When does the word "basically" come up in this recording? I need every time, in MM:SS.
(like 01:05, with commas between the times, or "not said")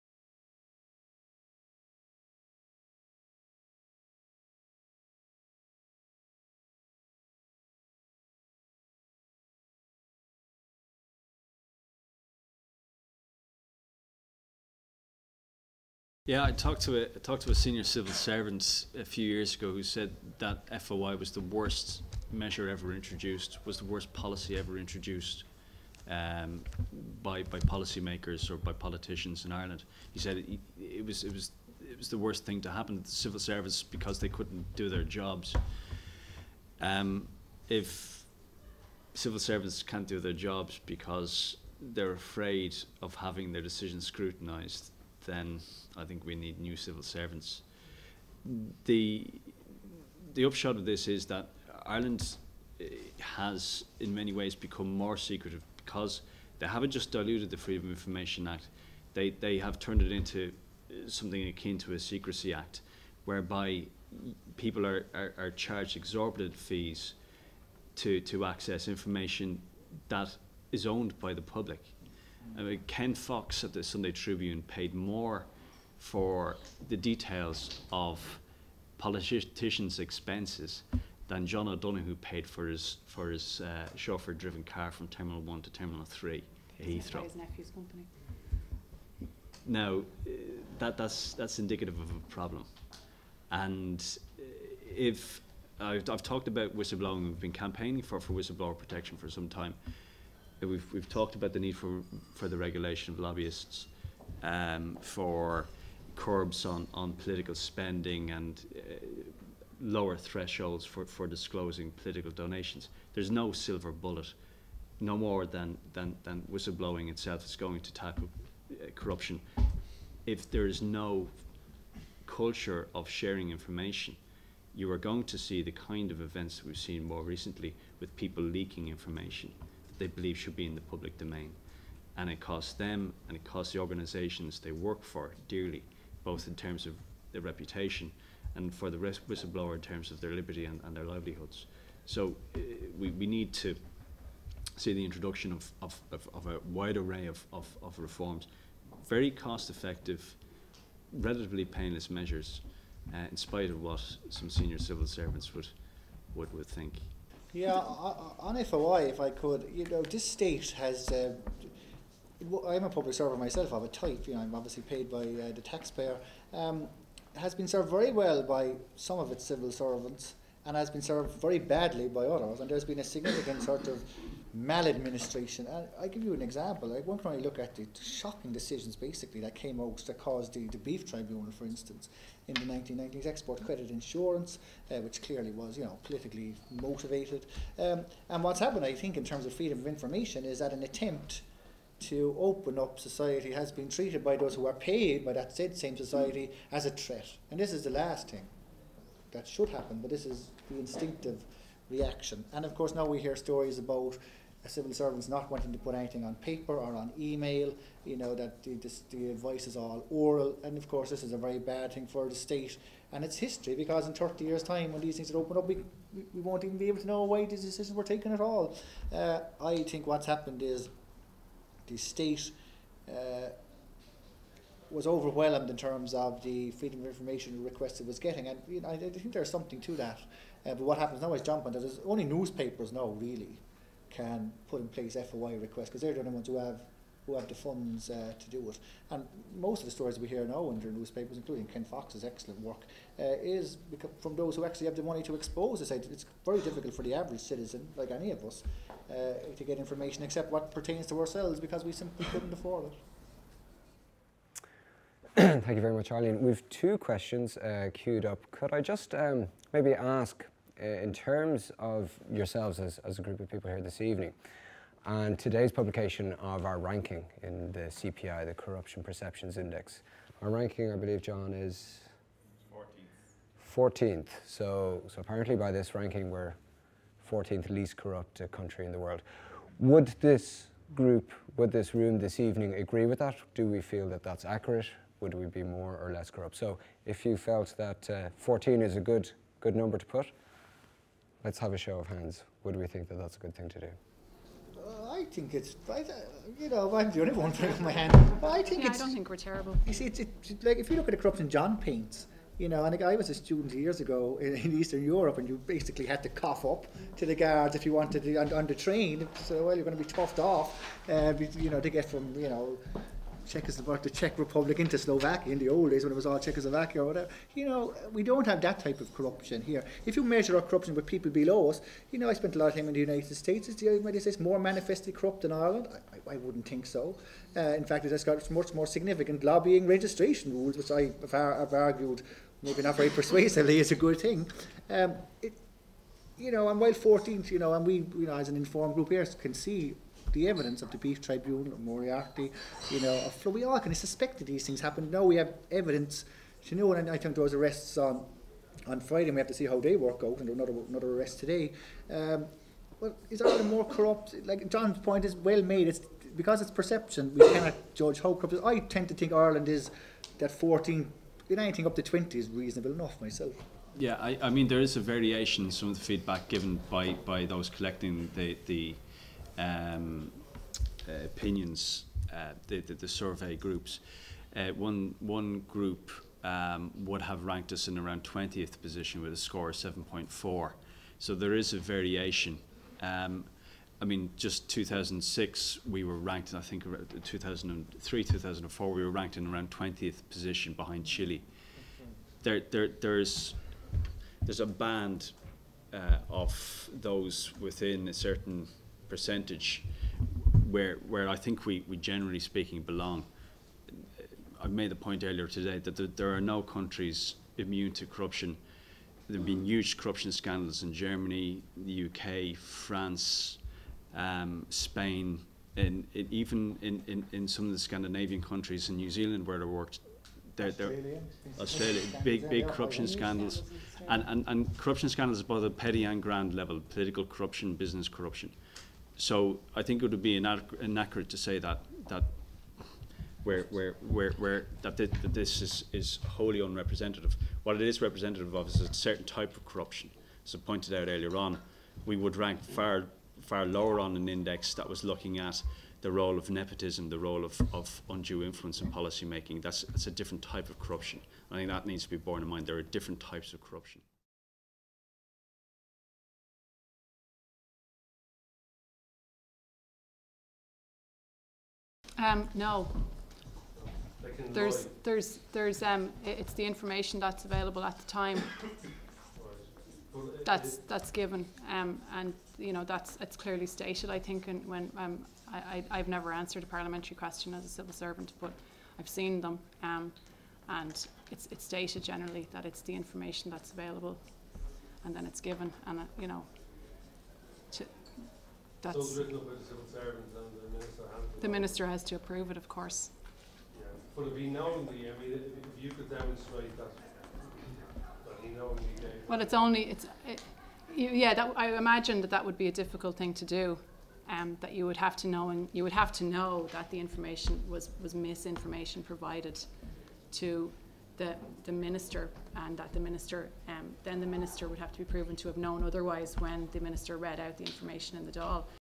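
02:58, 05:05.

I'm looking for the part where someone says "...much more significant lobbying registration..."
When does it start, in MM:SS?
05:28.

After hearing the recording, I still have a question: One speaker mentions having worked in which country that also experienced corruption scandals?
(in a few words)
New Zealand.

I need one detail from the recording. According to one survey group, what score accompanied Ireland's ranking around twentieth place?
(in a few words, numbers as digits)
7.4.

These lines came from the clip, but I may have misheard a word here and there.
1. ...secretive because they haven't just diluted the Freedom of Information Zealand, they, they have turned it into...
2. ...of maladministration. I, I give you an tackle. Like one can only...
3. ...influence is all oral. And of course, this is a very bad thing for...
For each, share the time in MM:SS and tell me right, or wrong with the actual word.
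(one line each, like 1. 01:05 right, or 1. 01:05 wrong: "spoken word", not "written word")
1. 00:55 wrong: "Act", not "Zealand"
2. 02:53 wrong: "example", not "tackle"
3. 03:29 wrong: "advice", not "influence".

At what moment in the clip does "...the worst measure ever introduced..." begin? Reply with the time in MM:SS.
00:21.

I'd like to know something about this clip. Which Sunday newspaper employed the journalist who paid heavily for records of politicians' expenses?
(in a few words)
Sunday Tribune.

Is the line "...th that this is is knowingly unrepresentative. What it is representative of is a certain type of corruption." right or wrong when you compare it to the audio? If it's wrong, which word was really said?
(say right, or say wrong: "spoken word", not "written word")
wrong: "wholly", not "knowingly".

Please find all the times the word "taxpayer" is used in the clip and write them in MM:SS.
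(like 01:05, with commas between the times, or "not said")
02:45.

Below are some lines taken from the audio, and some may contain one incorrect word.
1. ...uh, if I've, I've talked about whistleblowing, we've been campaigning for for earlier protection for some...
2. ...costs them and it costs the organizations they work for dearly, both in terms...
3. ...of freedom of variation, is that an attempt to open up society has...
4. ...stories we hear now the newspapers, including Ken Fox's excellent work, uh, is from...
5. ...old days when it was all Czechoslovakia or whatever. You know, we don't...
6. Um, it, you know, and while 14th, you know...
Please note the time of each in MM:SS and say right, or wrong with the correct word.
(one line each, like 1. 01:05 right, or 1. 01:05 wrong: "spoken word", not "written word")
1. 01:34 wrong: "whistleblower", not "earlier"
2. 02:12 right
3. 03:09 wrong: "information", not "variation"
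4. 03:59 right
5. 05:15 right
6. 05:34 right.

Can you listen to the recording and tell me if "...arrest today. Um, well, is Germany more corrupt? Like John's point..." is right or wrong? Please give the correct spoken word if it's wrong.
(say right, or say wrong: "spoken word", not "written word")
wrong: "Ireland", not "Germany".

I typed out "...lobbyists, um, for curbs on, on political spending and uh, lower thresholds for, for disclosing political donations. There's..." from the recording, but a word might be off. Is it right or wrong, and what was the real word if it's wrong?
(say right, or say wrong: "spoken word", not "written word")
right.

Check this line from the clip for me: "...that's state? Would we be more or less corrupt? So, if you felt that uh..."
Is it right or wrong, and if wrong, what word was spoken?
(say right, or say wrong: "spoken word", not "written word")
wrong: "accurate", not "state".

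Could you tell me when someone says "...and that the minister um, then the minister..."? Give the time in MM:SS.
08:32.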